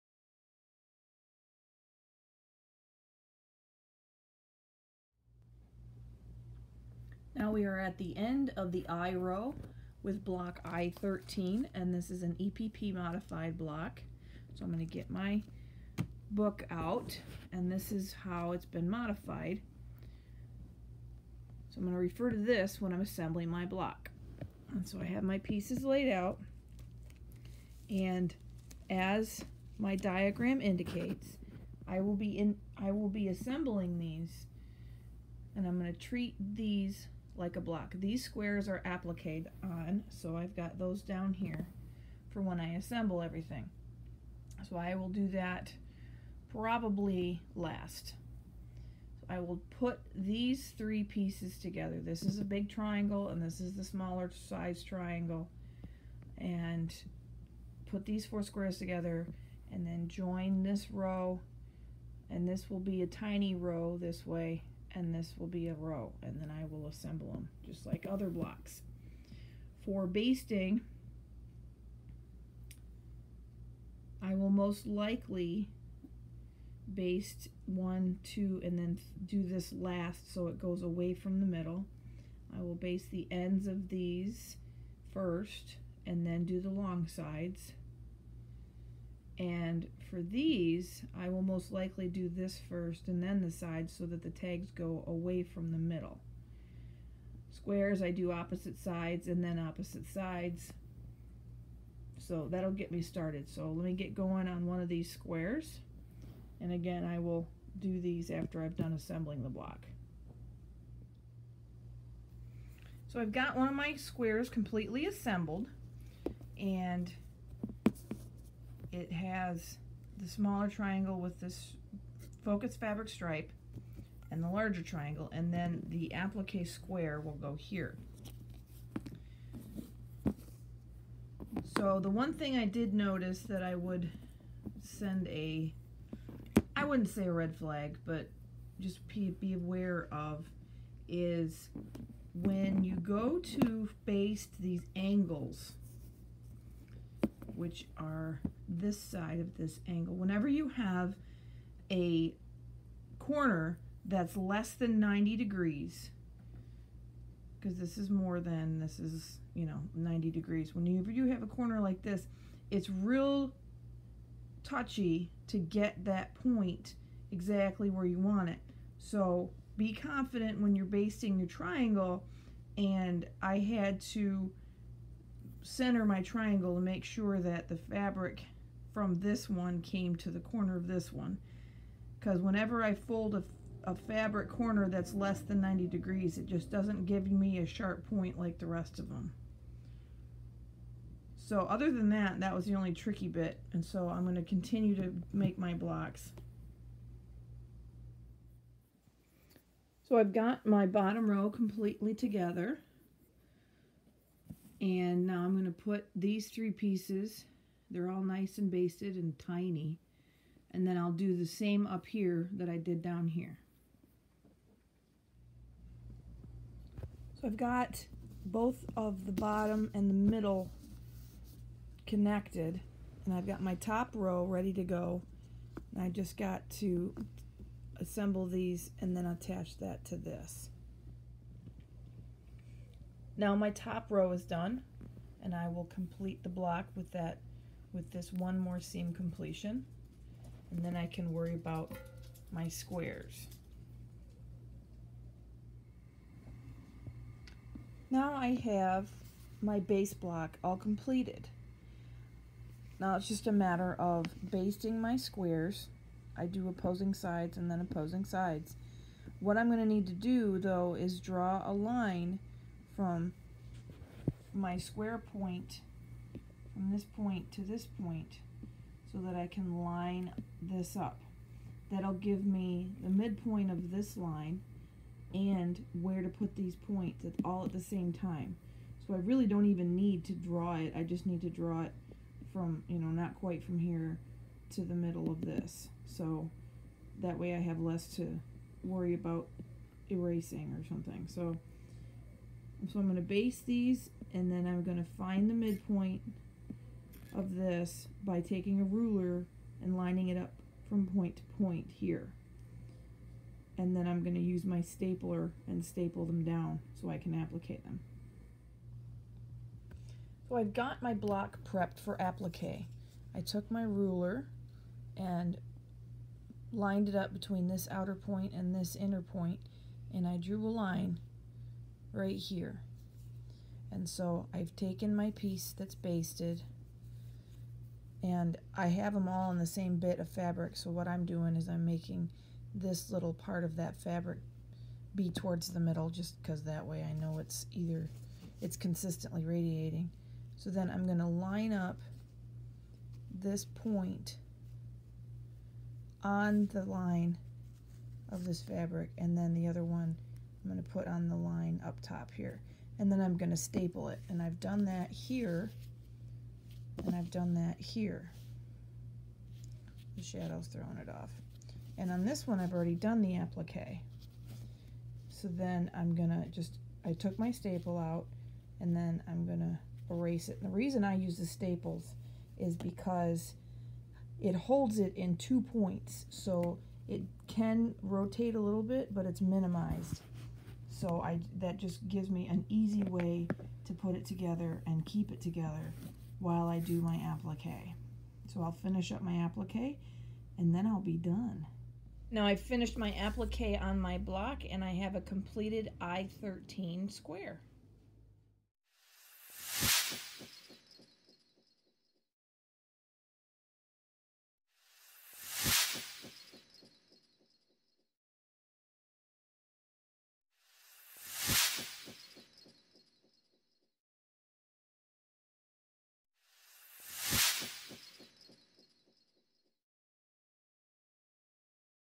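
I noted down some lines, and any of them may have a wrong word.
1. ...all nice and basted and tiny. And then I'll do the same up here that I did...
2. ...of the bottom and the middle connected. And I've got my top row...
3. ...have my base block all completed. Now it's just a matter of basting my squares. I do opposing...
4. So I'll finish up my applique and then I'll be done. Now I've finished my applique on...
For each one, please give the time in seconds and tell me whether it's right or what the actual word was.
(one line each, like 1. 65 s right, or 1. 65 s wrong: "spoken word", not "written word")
1. 208 s right
2. 218 s right
3. 248 s right
4. 388 s right.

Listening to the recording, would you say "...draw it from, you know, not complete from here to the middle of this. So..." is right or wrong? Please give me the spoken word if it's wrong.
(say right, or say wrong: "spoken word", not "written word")
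wrong: "quite", not "complete".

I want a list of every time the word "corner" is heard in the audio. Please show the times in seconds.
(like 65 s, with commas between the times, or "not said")
153 s, 161 s, 180 s, 184 s.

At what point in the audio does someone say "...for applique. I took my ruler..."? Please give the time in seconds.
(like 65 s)
311 s.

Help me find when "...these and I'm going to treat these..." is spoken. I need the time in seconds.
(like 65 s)
33 s.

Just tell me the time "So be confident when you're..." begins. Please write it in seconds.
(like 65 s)
168 s.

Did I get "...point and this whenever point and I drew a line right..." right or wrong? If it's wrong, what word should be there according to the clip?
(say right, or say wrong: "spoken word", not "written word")
wrong: "inner", not "whenever".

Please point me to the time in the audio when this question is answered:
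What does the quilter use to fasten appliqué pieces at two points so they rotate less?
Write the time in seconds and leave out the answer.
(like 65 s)
371 s.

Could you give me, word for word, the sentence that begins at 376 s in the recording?
So it can rotate a little bit, but it's minimized.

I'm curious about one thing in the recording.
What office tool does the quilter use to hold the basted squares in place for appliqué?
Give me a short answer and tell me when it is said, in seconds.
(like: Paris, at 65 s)
stapler, at 304 s.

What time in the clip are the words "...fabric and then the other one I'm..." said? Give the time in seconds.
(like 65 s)
348 s.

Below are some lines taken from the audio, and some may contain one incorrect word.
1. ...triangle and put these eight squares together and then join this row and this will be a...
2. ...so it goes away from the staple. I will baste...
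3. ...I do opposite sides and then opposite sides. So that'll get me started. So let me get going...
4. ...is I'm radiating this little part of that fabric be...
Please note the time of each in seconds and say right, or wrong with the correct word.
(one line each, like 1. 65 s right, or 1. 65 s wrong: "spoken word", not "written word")
1. 54 s wrong: "four", not "eight"
2. 80 s wrong: "middle", not "staple"
3. 98 s right
4. 331 s wrong: "making", not "radiating".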